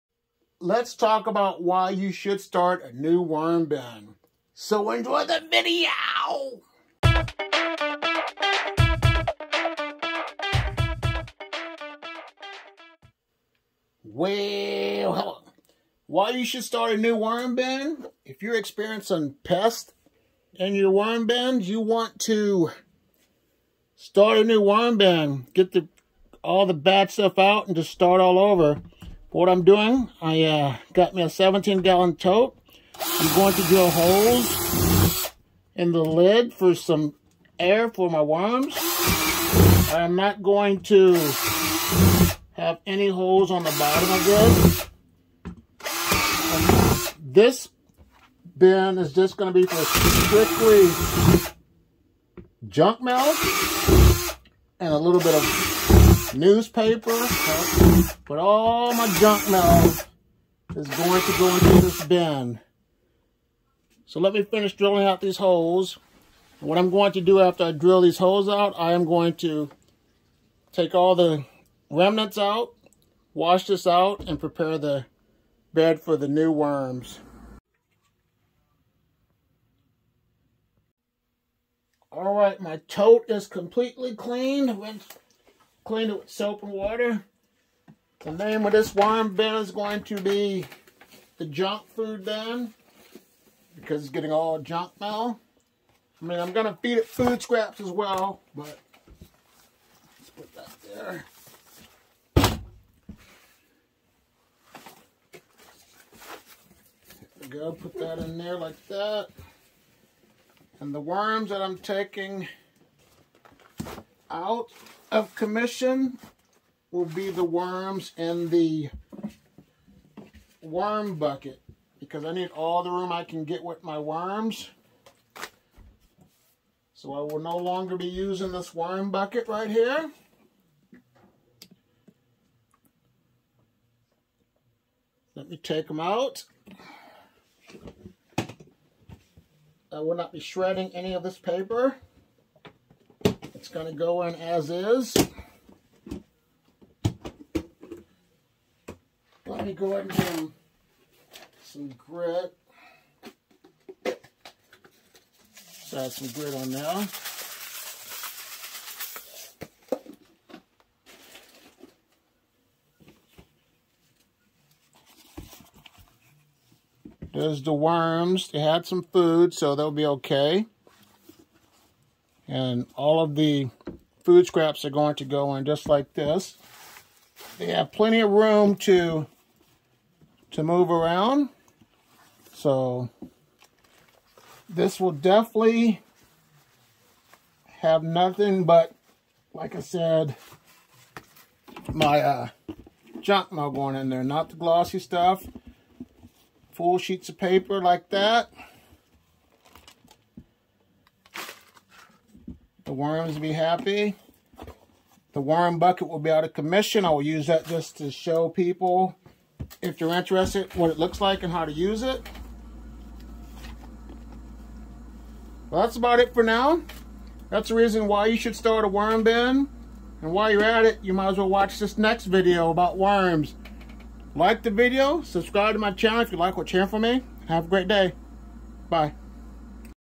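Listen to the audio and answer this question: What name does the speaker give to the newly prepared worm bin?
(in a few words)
the junk food bin.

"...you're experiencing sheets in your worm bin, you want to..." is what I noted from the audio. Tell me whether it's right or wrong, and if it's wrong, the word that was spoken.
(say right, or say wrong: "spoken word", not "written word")
wrong: "pests", not "sheets".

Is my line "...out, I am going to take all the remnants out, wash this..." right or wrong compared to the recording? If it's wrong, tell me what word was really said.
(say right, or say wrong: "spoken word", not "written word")
right.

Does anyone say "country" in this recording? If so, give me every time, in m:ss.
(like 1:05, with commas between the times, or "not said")
not said.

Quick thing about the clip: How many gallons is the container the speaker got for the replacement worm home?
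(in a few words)
17 gallon.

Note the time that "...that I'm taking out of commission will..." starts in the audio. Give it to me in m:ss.
1:51.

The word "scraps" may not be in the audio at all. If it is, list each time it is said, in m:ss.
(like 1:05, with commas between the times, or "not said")
1:37, 2:54.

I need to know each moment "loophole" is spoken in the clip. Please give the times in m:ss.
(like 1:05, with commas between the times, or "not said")
not said.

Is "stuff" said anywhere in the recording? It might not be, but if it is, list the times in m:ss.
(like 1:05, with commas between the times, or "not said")
0:27, 3:14.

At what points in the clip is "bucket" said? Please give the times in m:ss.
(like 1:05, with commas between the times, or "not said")
2:01, 2:09, 3:25.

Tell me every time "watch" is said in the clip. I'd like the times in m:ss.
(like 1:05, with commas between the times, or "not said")
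3:41.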